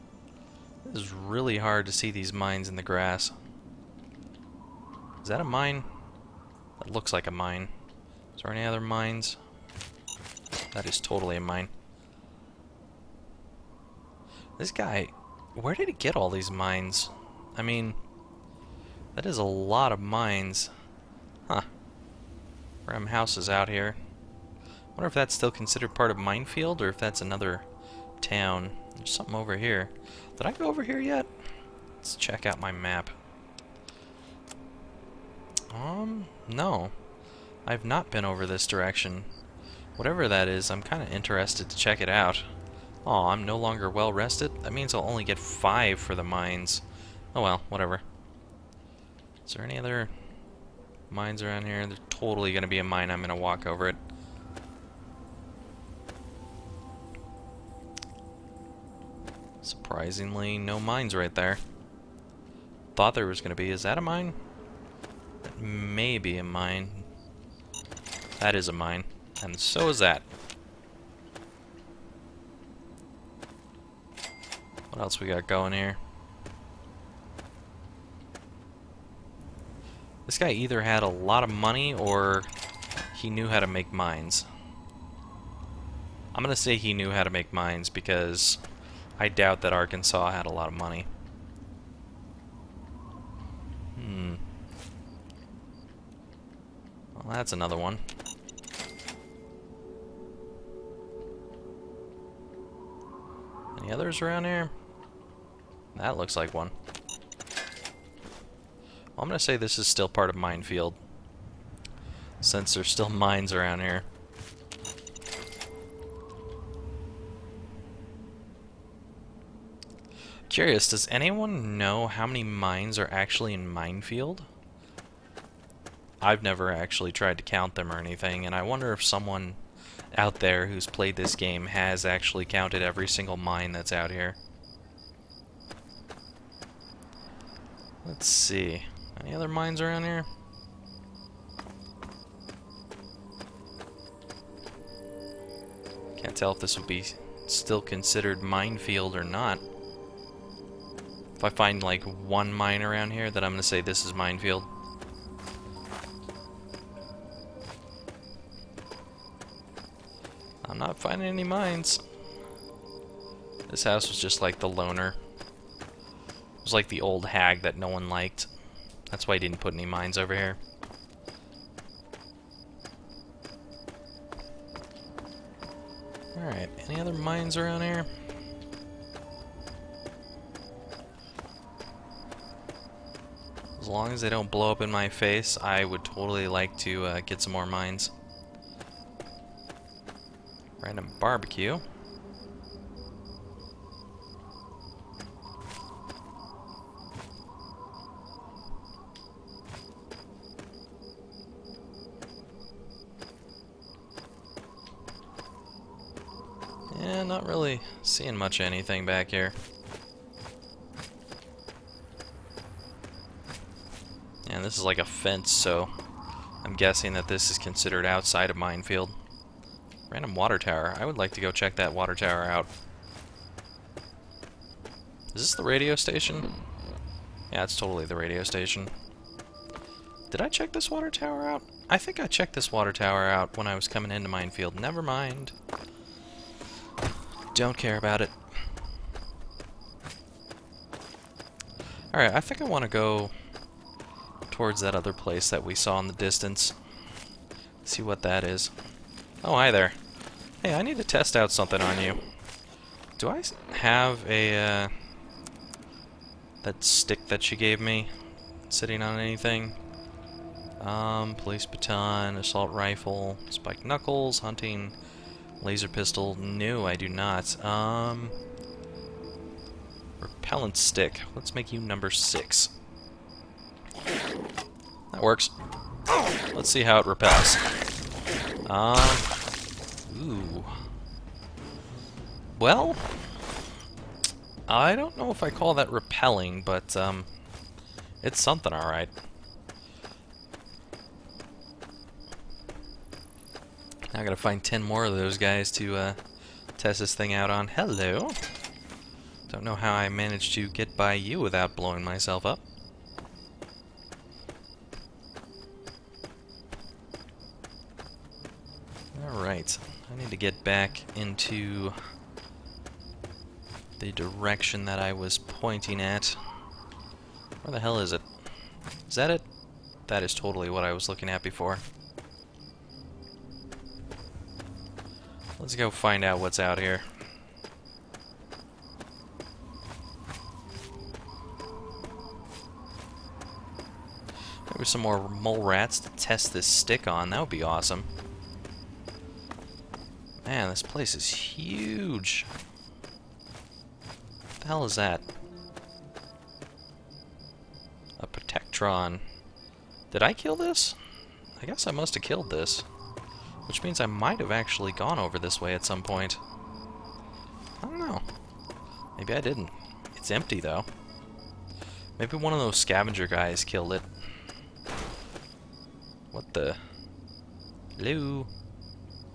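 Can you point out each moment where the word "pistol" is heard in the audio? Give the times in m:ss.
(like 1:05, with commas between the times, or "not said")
4:25.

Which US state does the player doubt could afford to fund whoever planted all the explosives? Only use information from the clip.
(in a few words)
Arkansas.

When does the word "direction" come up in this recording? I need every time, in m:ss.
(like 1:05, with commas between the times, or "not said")
0:38, 5:14.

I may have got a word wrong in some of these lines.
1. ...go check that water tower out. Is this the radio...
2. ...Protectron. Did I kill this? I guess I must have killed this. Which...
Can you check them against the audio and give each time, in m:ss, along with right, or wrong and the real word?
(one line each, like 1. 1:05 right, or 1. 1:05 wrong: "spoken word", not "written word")
1. 3:41 right
2. 5:48 right.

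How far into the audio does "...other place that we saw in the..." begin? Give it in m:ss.
4:04.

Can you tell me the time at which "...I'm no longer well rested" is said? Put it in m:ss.
0:43.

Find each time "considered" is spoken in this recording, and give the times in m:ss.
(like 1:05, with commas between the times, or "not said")
0:25, 2:27, 3:37.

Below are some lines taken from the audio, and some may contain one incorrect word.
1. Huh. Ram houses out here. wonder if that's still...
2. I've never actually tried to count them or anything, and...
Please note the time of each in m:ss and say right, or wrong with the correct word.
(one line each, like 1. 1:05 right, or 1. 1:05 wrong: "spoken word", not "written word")
1. 0:21 right
2. 2:06 right.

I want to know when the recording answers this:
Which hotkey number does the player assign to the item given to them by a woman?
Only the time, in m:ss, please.
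4:32.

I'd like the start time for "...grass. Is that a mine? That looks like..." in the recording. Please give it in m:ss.
0:02.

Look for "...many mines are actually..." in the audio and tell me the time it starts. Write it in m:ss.
2:02.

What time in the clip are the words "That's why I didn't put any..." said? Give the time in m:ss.
2:49.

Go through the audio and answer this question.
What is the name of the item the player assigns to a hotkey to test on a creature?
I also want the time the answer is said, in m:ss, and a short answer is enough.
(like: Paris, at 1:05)
repellent stick, at 4:30.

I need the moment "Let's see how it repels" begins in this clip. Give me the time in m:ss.
4:36.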